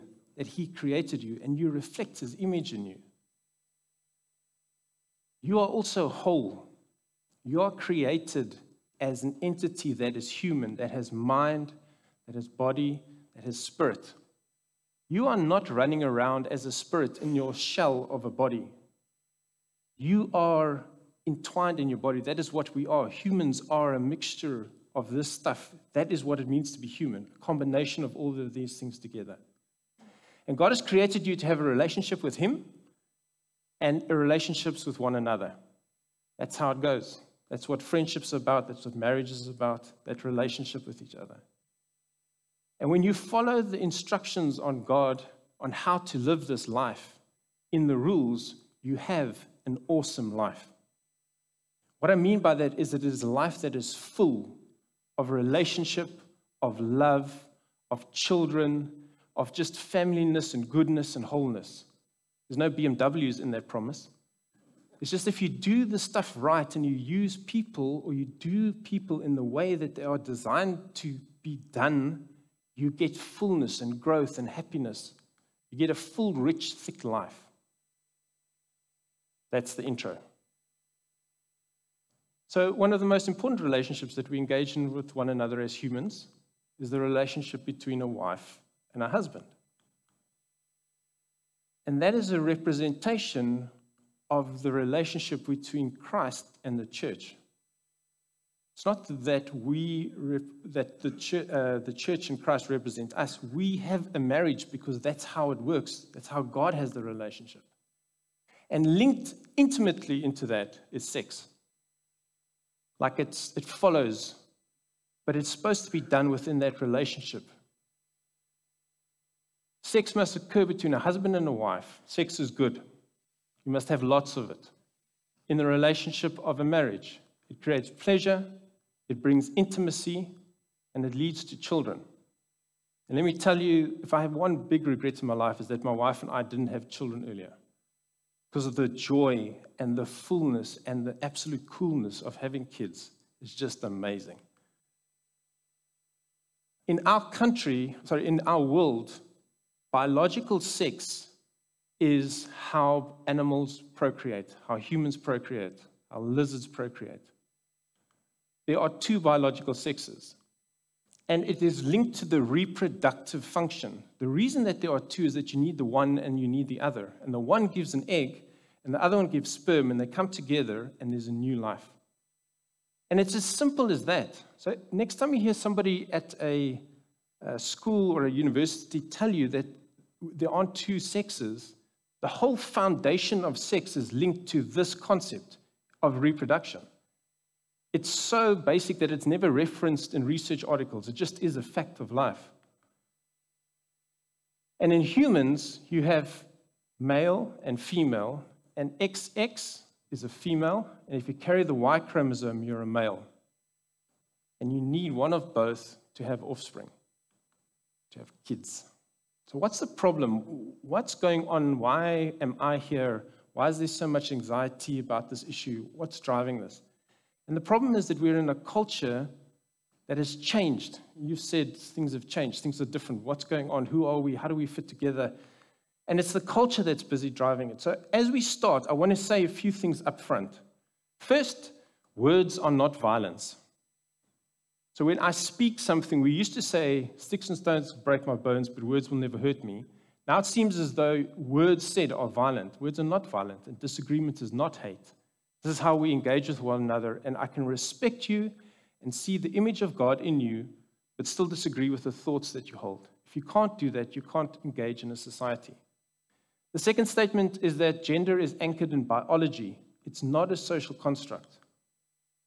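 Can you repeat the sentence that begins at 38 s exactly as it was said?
That's what marriage is about, that relationship with each other.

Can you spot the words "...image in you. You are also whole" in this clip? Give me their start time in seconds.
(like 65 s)
2 s.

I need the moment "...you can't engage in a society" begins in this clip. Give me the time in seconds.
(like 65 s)
254 s.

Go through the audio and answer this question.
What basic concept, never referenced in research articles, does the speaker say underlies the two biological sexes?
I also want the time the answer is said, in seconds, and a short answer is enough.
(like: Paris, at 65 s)
Reproduction, at 186 s.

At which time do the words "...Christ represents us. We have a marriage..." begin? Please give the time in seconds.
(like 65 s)
102 s.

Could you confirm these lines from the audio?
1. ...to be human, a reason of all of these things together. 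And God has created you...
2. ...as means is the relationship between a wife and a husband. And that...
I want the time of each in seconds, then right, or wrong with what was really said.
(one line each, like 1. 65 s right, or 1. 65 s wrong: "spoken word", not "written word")
1. 26 s wrong: "combination", not "reason"
2. 85 s wrong: "humans", not "means".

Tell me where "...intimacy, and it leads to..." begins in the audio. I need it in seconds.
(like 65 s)
129 s.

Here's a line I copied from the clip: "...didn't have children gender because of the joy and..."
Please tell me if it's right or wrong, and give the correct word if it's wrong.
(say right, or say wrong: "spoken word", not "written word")
wrong: "earlier", not "gender".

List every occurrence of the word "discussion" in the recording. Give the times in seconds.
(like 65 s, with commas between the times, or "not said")
not said.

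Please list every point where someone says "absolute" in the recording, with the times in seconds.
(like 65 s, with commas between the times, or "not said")
141 s.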